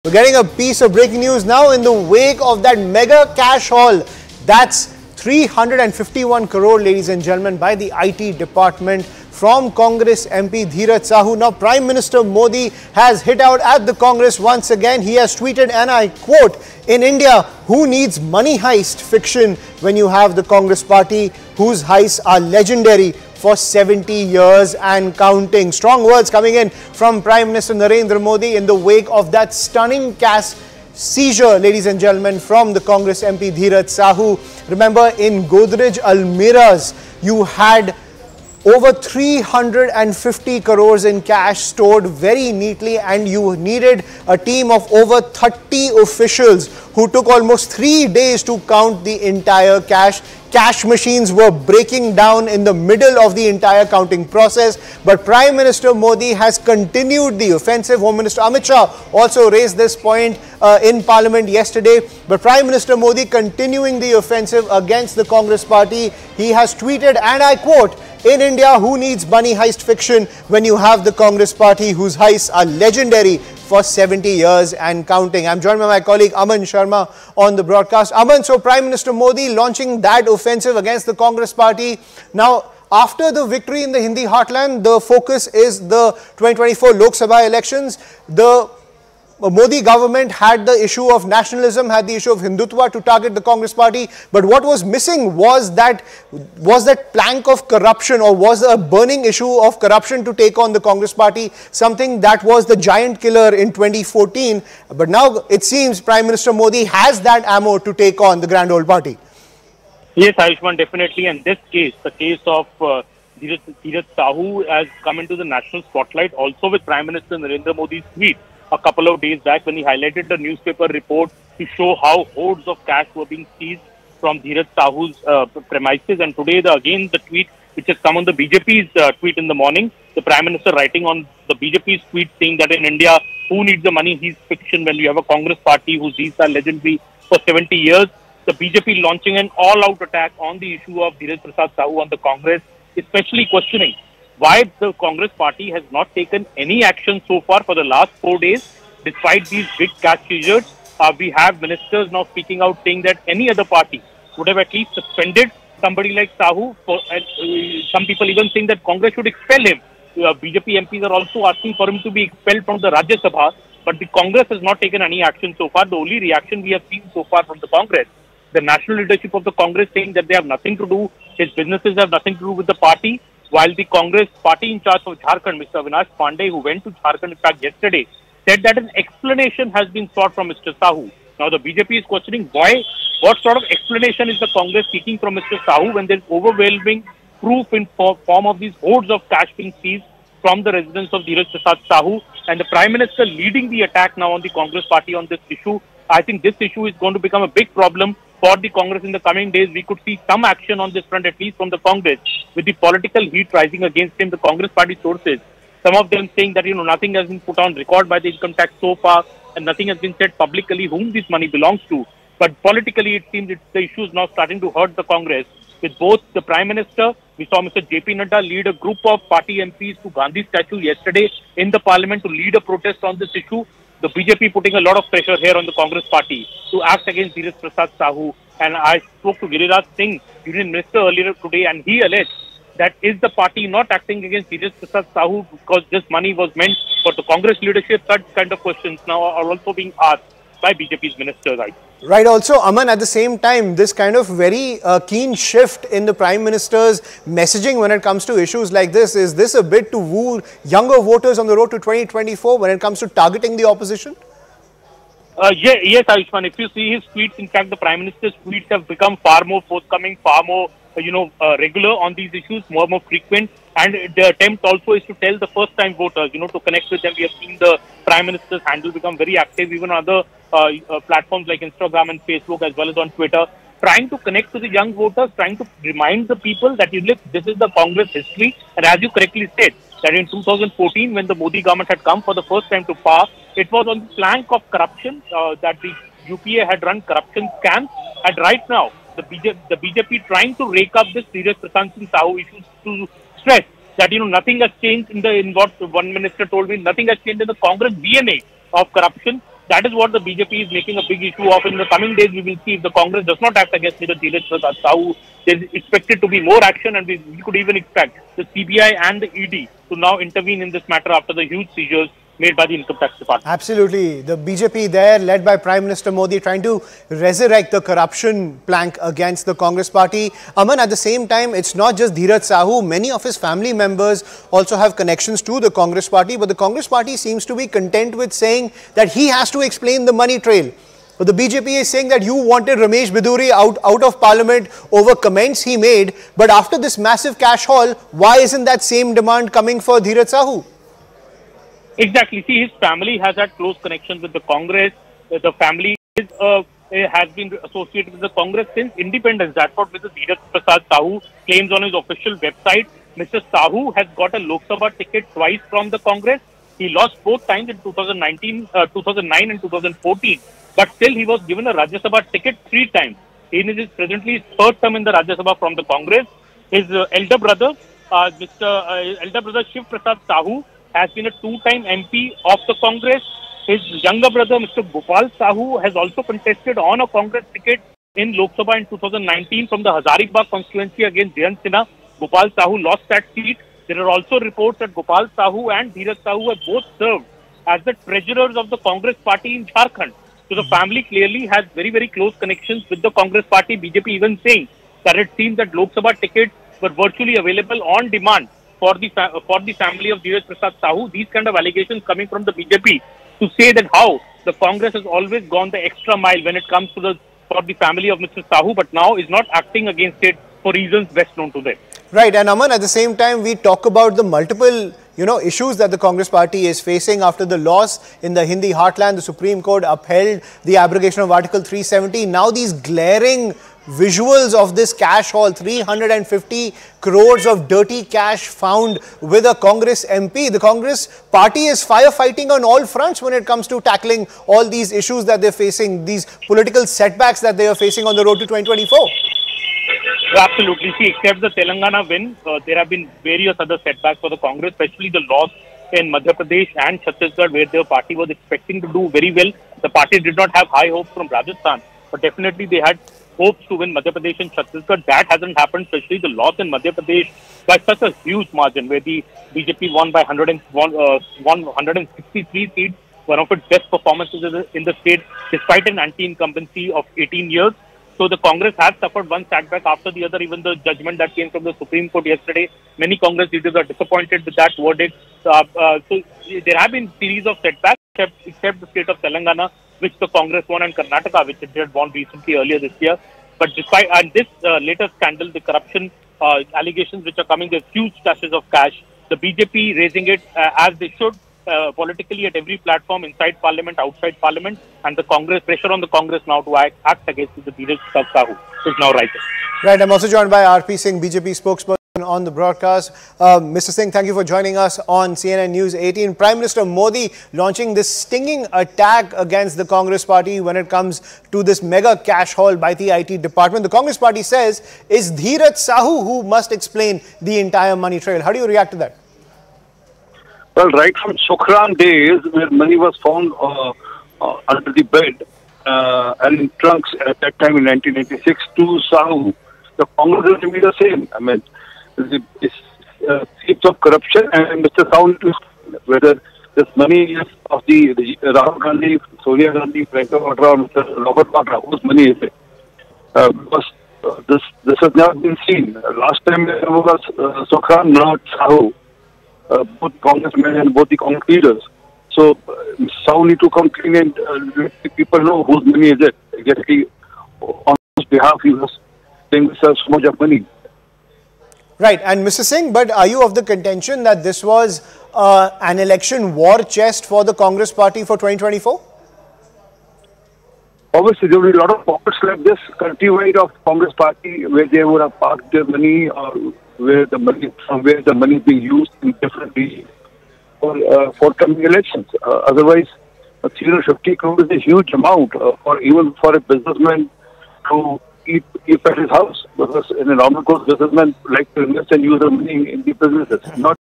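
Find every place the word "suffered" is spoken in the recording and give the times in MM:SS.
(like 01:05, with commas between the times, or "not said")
07:48.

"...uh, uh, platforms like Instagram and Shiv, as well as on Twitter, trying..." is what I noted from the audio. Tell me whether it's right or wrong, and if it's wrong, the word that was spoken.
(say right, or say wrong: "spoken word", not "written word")
wrong: "Facebook", not "Shiv".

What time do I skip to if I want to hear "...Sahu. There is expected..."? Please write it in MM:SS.
05:04.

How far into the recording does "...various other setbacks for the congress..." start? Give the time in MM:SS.
07:23.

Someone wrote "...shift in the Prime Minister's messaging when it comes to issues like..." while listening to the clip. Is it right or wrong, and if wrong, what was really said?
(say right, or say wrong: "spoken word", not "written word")
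right.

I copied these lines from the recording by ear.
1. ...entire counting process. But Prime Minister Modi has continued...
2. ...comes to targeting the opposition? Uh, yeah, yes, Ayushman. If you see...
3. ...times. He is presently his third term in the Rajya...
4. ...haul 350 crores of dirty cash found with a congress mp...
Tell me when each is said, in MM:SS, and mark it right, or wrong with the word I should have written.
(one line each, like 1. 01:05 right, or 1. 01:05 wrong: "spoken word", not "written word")
1. 00:53 right
2. 04:12 right
3. 06:02 right
4. 07:05 right.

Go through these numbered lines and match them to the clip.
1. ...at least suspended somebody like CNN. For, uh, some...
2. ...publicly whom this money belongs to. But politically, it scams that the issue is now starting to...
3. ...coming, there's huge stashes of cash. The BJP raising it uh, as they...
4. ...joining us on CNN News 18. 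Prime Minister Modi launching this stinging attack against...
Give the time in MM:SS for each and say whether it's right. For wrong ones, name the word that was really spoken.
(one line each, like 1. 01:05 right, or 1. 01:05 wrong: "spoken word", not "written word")
1. 02:34 wrong: "Sahu", not "CNN"
2. 03:30 wrong: "seems", not "scams"
3. 08:07 right
4. 08:24 right.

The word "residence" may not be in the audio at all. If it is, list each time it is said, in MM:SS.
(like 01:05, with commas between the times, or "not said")
03:10.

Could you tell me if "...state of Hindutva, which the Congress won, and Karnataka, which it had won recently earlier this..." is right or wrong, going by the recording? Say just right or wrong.
wrong.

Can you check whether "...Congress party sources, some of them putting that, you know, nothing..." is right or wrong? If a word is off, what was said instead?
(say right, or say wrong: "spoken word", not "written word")
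wrong: "saying", not "putting".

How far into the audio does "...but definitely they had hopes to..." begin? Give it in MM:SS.
07:32.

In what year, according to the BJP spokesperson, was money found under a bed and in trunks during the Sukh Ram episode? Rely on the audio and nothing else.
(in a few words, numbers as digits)
1986.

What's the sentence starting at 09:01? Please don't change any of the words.
Robert Vadra, whose money is it?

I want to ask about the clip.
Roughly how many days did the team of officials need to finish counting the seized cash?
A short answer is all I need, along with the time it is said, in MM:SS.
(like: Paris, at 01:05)
3 days, at 00:47.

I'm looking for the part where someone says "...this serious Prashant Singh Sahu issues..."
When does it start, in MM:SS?
04:51.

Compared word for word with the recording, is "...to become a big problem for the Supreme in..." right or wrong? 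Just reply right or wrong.
wrong.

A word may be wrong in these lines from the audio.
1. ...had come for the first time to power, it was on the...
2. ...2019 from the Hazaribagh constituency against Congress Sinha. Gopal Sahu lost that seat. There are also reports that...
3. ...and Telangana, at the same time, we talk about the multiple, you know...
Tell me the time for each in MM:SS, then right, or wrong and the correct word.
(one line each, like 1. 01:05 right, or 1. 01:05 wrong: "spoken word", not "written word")
1. 04:41 right
2. 06:18 wrong: "Jayant", not "Congress"
3. 06:52 wrong: "Aman", not "Telangana".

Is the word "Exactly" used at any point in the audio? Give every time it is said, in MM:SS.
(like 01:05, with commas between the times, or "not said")
05:42, 09:16.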